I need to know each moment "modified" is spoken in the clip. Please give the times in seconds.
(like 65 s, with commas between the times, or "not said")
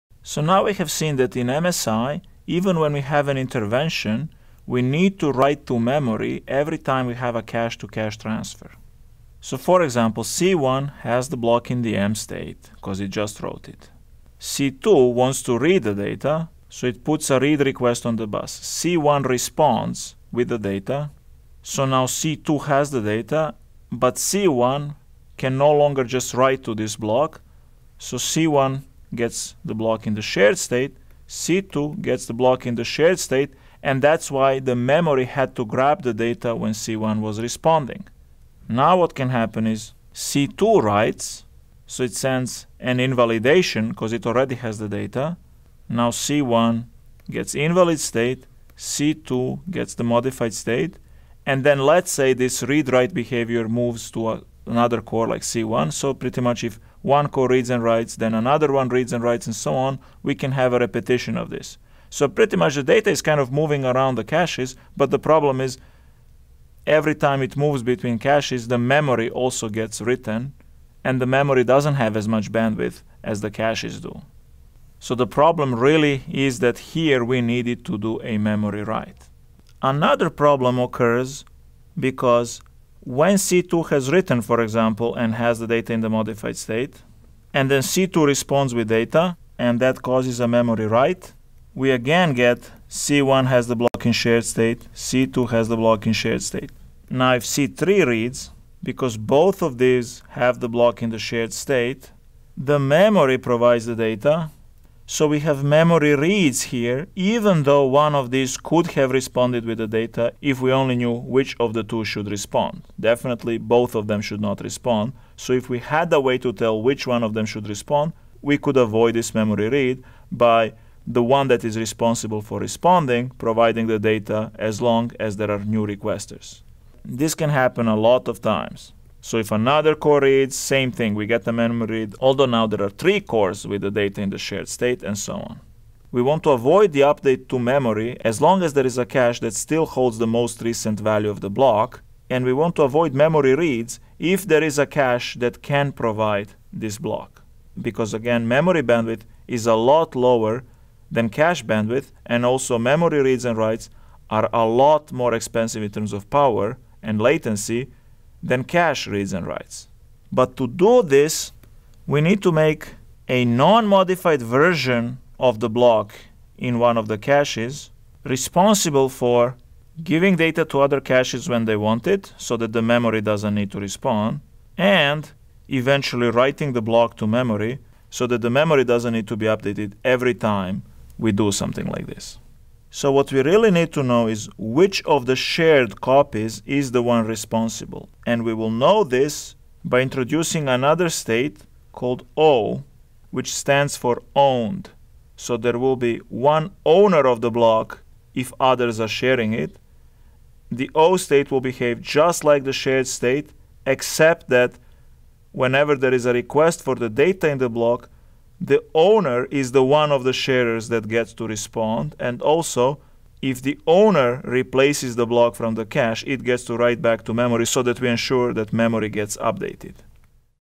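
50 s, 86 s, 163 s.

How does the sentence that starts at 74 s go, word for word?
So the problem really is that here we needed to do a memory write.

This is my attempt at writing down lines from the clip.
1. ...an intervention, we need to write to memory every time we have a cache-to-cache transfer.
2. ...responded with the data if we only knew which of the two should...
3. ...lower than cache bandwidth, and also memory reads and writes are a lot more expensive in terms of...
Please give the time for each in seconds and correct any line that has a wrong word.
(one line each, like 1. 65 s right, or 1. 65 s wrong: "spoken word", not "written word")
1. 3 s right
2. 109 s right
3. 150 s right.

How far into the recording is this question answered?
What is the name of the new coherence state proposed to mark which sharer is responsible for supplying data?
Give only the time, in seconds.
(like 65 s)
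194 s.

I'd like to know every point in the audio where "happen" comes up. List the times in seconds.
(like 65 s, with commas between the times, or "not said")
39 s, 127 s.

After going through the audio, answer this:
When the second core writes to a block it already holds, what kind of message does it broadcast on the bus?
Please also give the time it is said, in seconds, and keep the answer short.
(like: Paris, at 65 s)
an invalidation, at 42 s.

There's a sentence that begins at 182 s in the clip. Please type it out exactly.
So what we really need to know is which of the shared copies is the one responsible.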